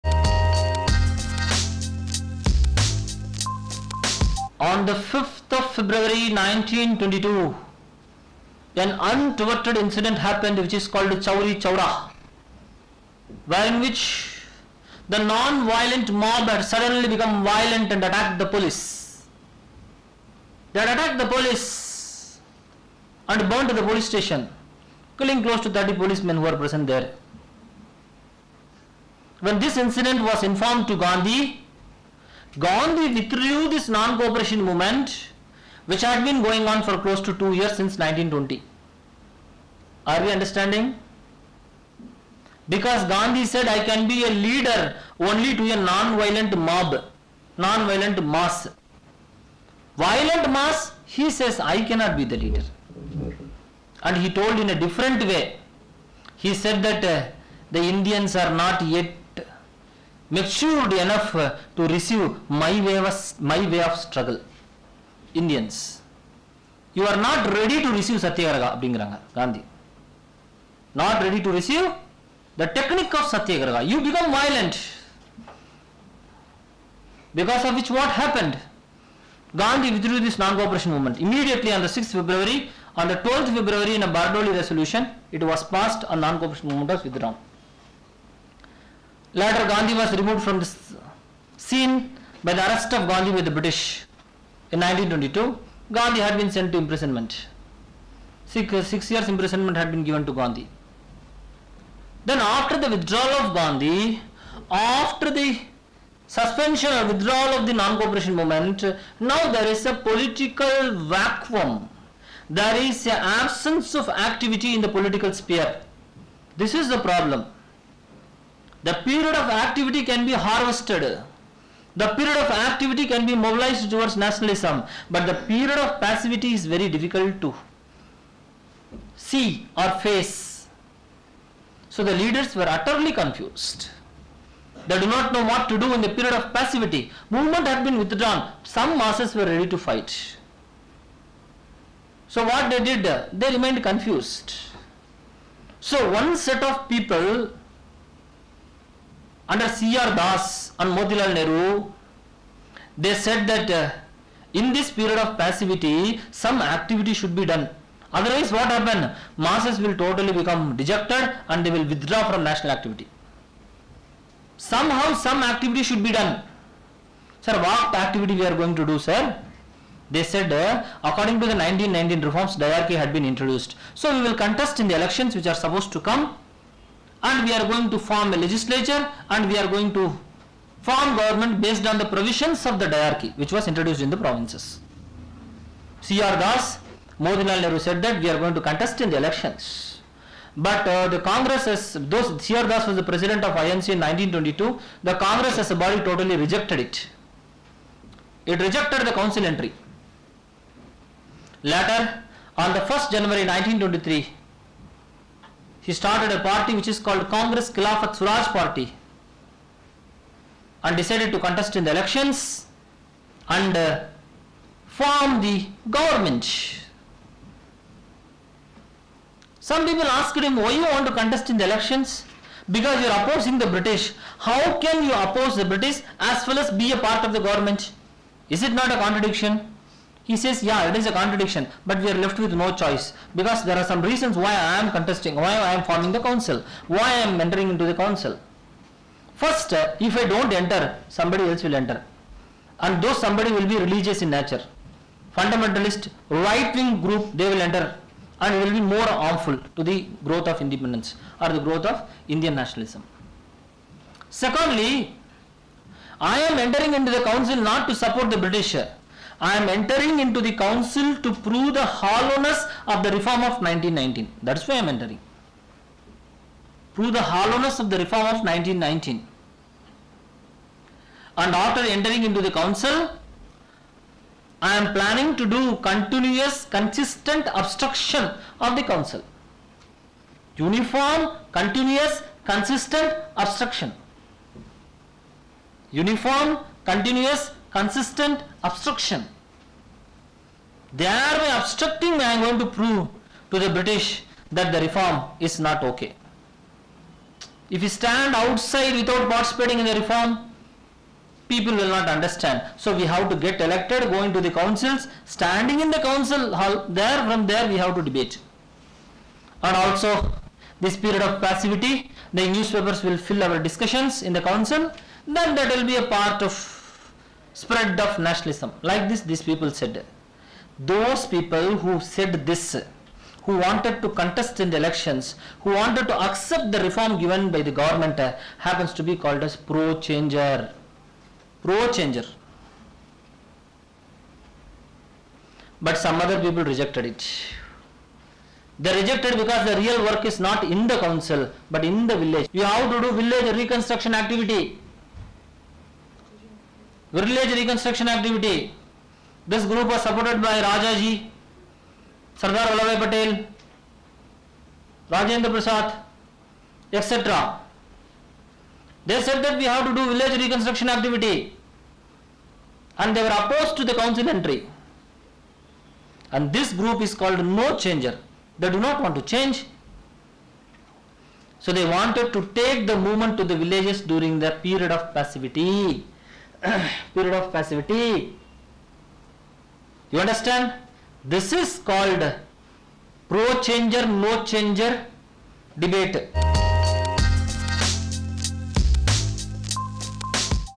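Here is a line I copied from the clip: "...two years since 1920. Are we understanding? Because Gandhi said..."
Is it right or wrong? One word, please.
right.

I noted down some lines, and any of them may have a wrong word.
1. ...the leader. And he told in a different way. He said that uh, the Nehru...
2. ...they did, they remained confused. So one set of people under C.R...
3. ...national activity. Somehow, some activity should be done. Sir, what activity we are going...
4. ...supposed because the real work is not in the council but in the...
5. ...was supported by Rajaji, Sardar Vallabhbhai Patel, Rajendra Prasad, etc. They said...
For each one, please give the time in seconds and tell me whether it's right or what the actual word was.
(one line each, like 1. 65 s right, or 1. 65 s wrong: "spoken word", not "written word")
1. 52 s wrong: "Indians", not "Nehru"
2. 142 s right
3. 162 s right
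4. 338 s wrong: "rejected", not "supposed"
5. 349 s right.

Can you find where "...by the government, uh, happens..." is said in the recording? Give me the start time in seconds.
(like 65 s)
327 s.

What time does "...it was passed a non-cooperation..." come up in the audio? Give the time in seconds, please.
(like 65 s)
85 s.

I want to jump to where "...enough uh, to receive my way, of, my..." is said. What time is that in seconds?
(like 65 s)
60 s.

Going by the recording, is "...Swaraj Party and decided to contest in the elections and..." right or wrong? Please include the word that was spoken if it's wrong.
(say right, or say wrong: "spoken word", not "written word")
right.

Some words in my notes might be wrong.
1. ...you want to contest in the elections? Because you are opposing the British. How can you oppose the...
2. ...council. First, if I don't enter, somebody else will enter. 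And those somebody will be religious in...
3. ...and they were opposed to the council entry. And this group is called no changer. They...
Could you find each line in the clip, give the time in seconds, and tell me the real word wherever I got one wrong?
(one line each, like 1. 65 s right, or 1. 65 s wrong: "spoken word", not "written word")
1. 220 s right
2. 237 s right
3. 362 s right.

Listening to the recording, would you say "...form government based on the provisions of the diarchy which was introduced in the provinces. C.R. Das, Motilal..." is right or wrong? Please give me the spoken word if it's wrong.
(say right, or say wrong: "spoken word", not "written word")
right.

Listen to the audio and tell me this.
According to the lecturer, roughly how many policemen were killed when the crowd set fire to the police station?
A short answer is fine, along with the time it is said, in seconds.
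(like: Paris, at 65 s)
30, at 25 s.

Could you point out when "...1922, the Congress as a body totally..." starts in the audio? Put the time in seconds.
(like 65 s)
194 s.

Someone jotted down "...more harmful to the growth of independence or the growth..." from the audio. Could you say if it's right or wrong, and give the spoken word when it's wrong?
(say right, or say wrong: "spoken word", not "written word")
right.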